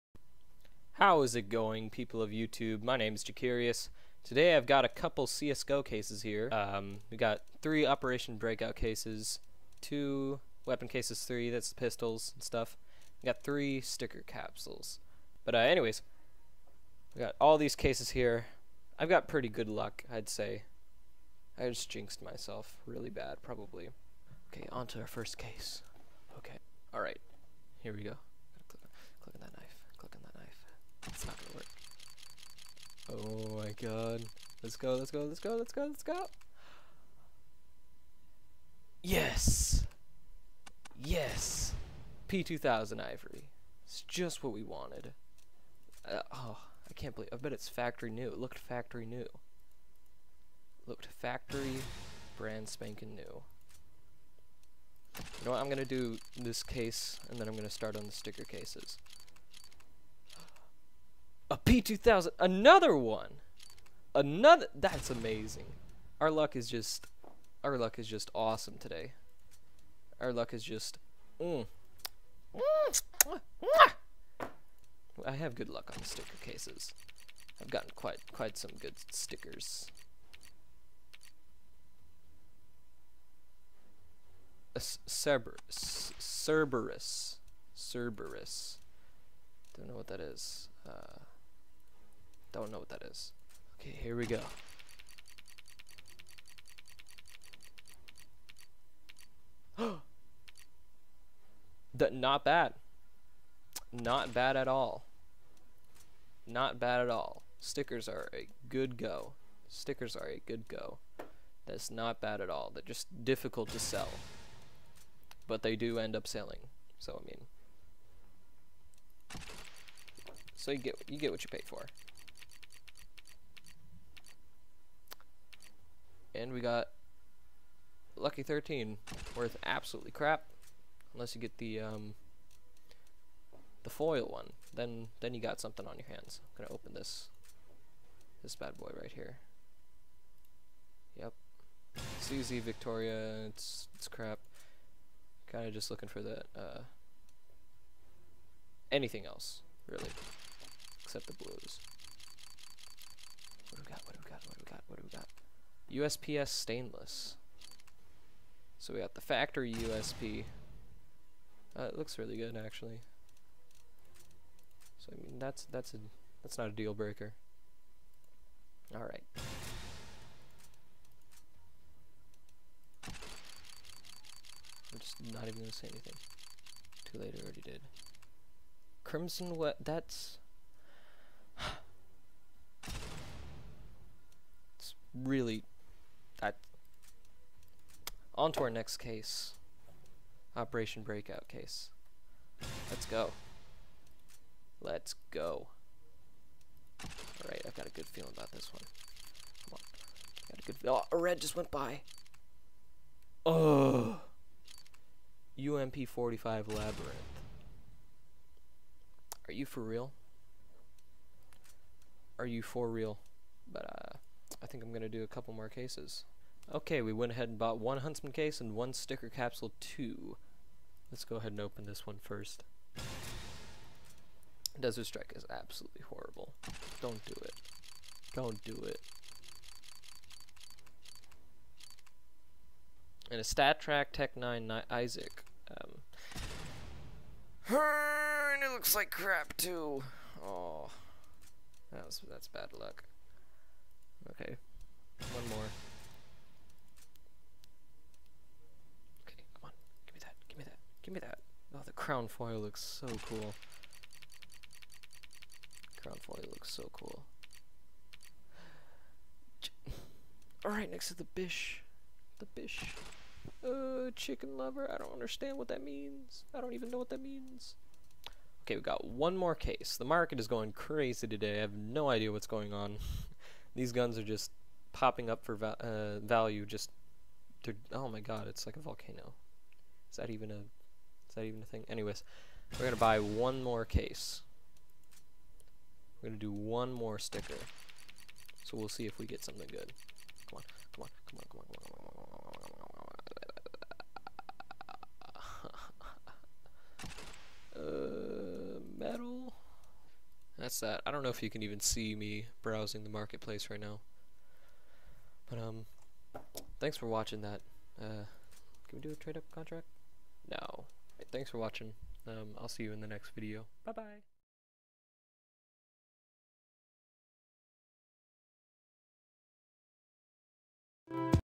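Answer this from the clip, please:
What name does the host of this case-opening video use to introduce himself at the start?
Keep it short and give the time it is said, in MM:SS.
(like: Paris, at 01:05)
Jakerious, at 00:03.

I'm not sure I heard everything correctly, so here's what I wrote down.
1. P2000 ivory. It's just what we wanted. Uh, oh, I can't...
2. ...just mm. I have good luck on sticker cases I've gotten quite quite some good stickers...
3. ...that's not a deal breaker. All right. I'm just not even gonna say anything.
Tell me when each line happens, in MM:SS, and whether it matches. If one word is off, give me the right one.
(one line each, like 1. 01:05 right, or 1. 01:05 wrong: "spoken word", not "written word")
1. 00:42 right
2. 01:10 right
3. 02:46 right.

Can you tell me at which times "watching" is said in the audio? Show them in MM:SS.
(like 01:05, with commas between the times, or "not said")
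05:07, 05:11.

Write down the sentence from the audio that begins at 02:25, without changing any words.
Kind of just looking for that uh, anything else really, except the blues.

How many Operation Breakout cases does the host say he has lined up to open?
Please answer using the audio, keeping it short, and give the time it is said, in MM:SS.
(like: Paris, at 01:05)
3, at 00:07.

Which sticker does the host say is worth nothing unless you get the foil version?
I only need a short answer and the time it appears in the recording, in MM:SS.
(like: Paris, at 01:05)
Lucky 13, at 02:08.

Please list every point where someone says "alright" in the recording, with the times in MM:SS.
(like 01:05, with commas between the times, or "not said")
00:26, 03:17, 04:20.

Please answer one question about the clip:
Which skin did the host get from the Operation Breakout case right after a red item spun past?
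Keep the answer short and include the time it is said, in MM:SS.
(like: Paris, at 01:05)
UMP-45 Labyrinth, at 03:25.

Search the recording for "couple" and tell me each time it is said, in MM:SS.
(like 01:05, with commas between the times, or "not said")
00:04, 03:35.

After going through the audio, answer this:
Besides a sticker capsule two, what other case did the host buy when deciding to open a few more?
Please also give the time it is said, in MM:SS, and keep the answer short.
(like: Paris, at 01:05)
Huntsman case, at 03:37.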